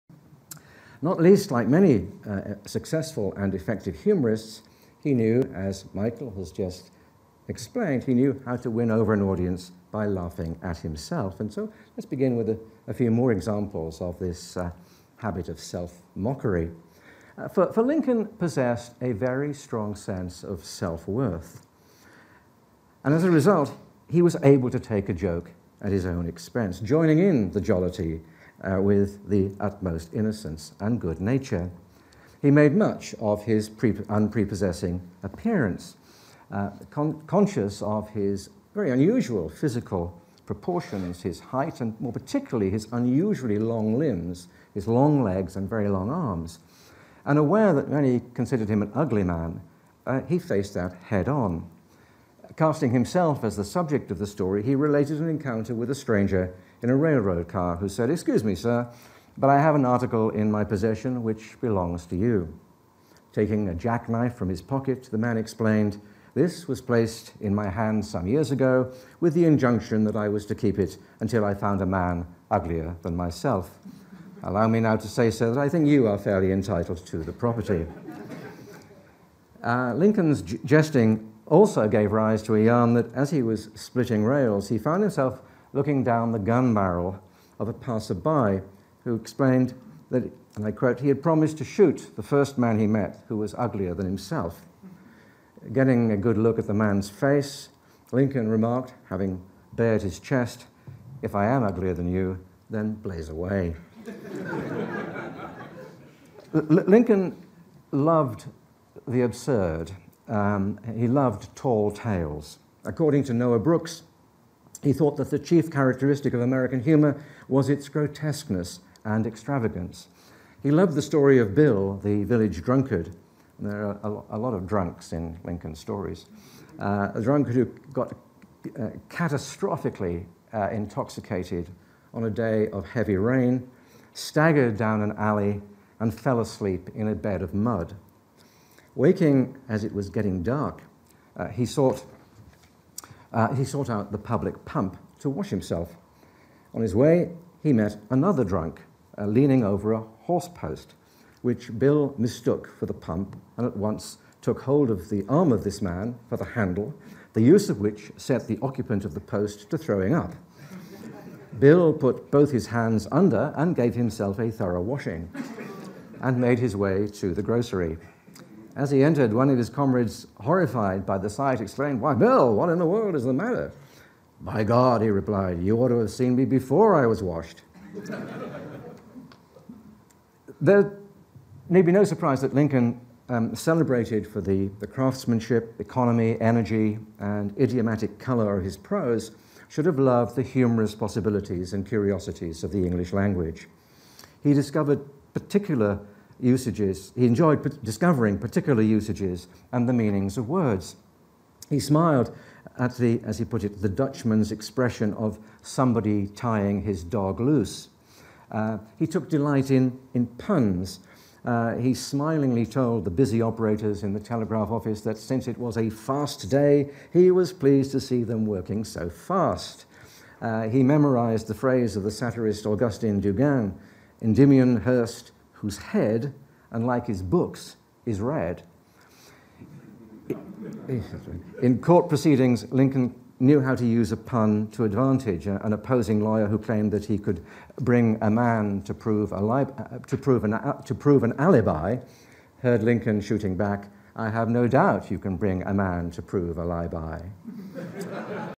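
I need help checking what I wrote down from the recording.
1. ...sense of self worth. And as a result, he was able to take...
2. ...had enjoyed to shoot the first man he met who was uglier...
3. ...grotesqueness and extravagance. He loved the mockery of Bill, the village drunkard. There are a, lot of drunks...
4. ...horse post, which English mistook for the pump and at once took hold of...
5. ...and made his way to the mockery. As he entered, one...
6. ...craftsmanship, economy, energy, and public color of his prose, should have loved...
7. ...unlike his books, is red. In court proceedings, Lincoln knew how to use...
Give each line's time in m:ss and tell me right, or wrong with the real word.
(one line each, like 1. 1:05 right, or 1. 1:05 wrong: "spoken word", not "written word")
1. 0:19 right
2. 1:31 wrong: "promised", not "enjoyed"
3. 1:57 wrong: "story", not "mockery"
4. 2:30 wrong: "Bill", not "English"
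5. 2:46 wrong: "grocery", not "mockery"
6. 3:04 wrong: "idiomatic", not "public"
7. 3:46 right.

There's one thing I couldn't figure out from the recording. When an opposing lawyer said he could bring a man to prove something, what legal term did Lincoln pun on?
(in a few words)
Alibi.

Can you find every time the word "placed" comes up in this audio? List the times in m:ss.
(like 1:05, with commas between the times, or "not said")
1:06.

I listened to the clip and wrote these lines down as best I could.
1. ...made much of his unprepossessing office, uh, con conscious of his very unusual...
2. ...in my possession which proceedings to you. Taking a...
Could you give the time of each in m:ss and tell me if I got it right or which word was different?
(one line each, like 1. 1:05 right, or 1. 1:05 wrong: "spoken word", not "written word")
1. 0:32 wrong: "appearance", not "office"
2. 1:00 wrong: "belongs", not "proceedings".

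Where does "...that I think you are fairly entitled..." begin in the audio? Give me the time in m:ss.
1:15.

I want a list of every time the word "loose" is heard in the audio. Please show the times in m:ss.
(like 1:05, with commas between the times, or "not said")
3:27.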